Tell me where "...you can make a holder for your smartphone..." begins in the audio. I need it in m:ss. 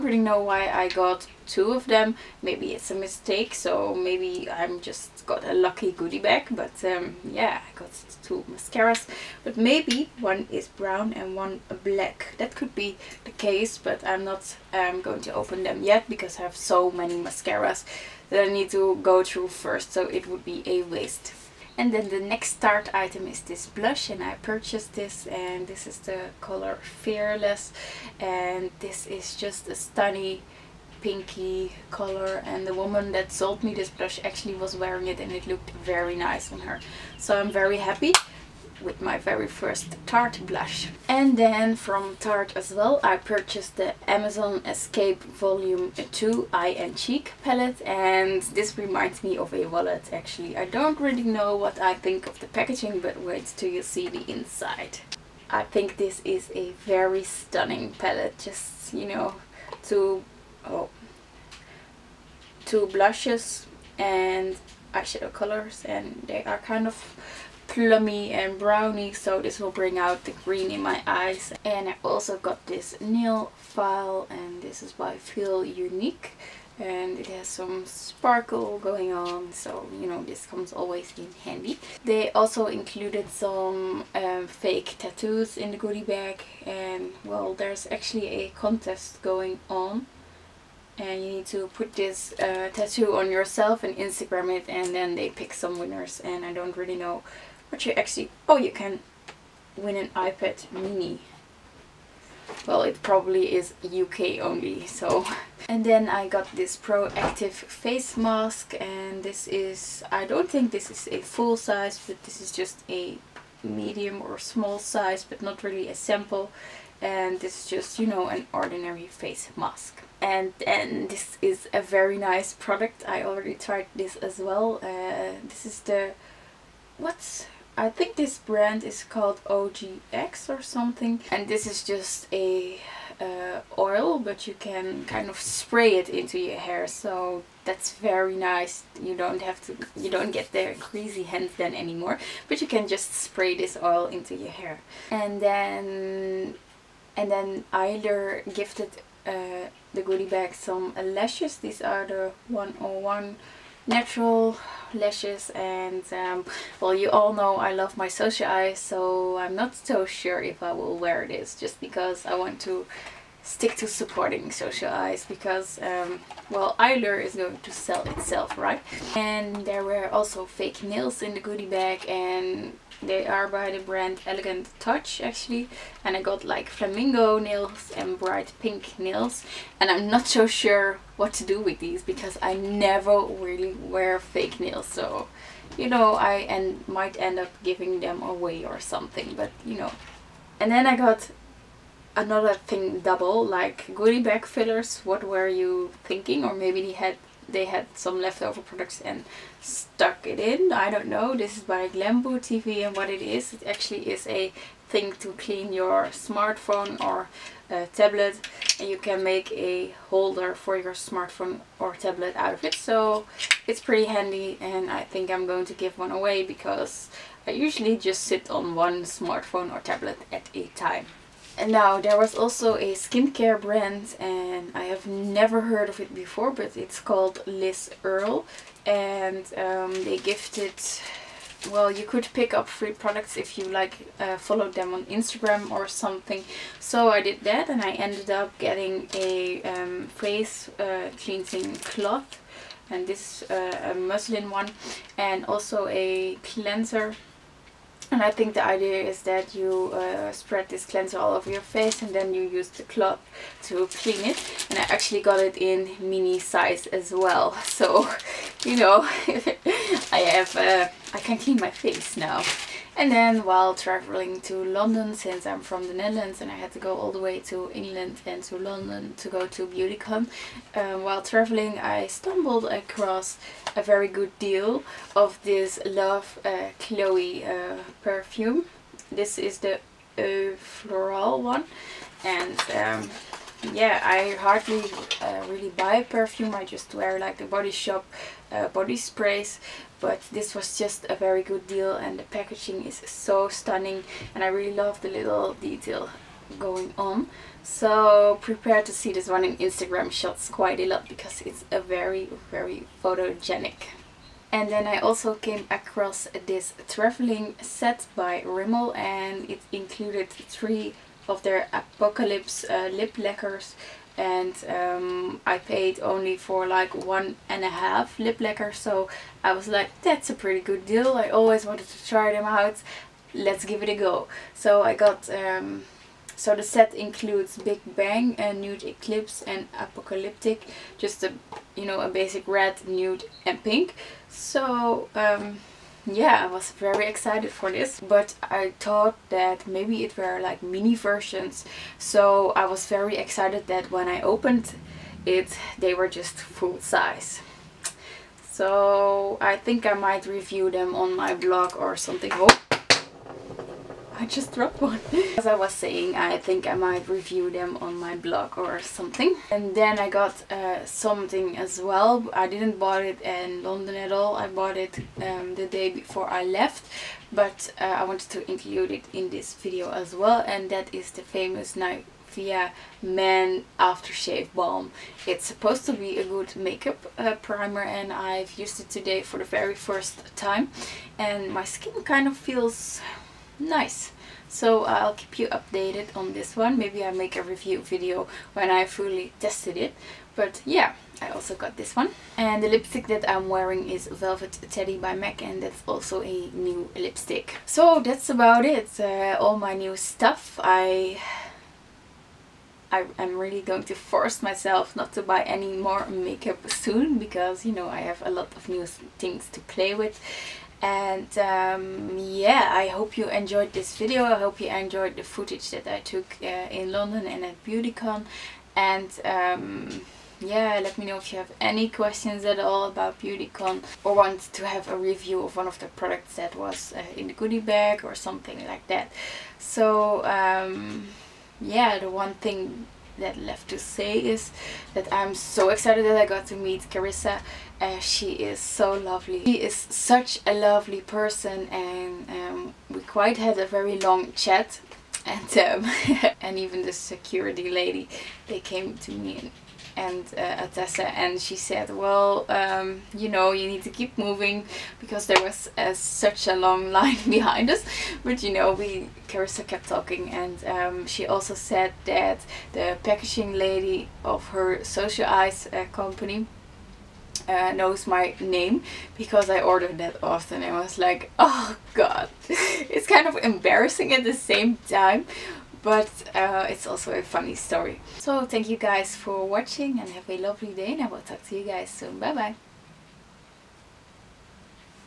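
3:28.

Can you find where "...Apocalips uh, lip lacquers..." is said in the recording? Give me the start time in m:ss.
5:11.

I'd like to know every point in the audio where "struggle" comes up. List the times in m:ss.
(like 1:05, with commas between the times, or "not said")
not said.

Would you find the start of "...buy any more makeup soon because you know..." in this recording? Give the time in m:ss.
6:45.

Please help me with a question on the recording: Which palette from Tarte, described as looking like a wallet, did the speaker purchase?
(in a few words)
Amazon Escape Volume 2.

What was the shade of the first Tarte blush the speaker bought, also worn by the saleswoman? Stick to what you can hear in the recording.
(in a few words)
Fearless.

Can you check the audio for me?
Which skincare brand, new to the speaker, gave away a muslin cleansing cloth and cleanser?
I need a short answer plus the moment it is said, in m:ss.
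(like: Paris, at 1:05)
Liz Earle, at 3:47.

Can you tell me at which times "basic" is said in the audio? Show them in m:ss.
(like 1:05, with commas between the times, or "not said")
5:32.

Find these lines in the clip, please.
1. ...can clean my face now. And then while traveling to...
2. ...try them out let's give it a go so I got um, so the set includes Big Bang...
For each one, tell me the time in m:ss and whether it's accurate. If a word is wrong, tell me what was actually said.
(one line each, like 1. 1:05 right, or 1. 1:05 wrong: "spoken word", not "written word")
1. 4:21 right
2. 5:22 right.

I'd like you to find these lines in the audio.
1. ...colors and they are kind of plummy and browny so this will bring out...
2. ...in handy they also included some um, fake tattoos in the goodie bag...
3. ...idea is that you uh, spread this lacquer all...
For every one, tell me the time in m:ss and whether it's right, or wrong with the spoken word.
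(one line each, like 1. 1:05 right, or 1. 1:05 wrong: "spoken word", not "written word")
1. 1:05 right
2. 1:21 right
3. 4:08 wrong: "cleanser", not "lacquer".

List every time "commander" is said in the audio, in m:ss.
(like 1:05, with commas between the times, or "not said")
not said.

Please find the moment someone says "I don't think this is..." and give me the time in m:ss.
1:50.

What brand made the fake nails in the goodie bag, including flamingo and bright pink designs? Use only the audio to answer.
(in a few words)
Elegant Touch.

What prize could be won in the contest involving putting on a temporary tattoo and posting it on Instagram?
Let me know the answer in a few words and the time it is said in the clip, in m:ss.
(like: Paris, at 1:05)
iPad mini, at 1:40.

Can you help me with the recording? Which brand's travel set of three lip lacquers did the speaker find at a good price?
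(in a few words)
Rimmel.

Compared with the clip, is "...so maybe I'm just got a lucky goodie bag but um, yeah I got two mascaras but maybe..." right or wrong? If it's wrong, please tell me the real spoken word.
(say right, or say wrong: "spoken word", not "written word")
right.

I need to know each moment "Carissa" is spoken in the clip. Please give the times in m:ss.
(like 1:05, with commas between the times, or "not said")
7:16, 7:39.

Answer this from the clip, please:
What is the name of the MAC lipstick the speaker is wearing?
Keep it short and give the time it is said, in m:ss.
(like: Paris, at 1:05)
Velvet Teddy, at 6:34.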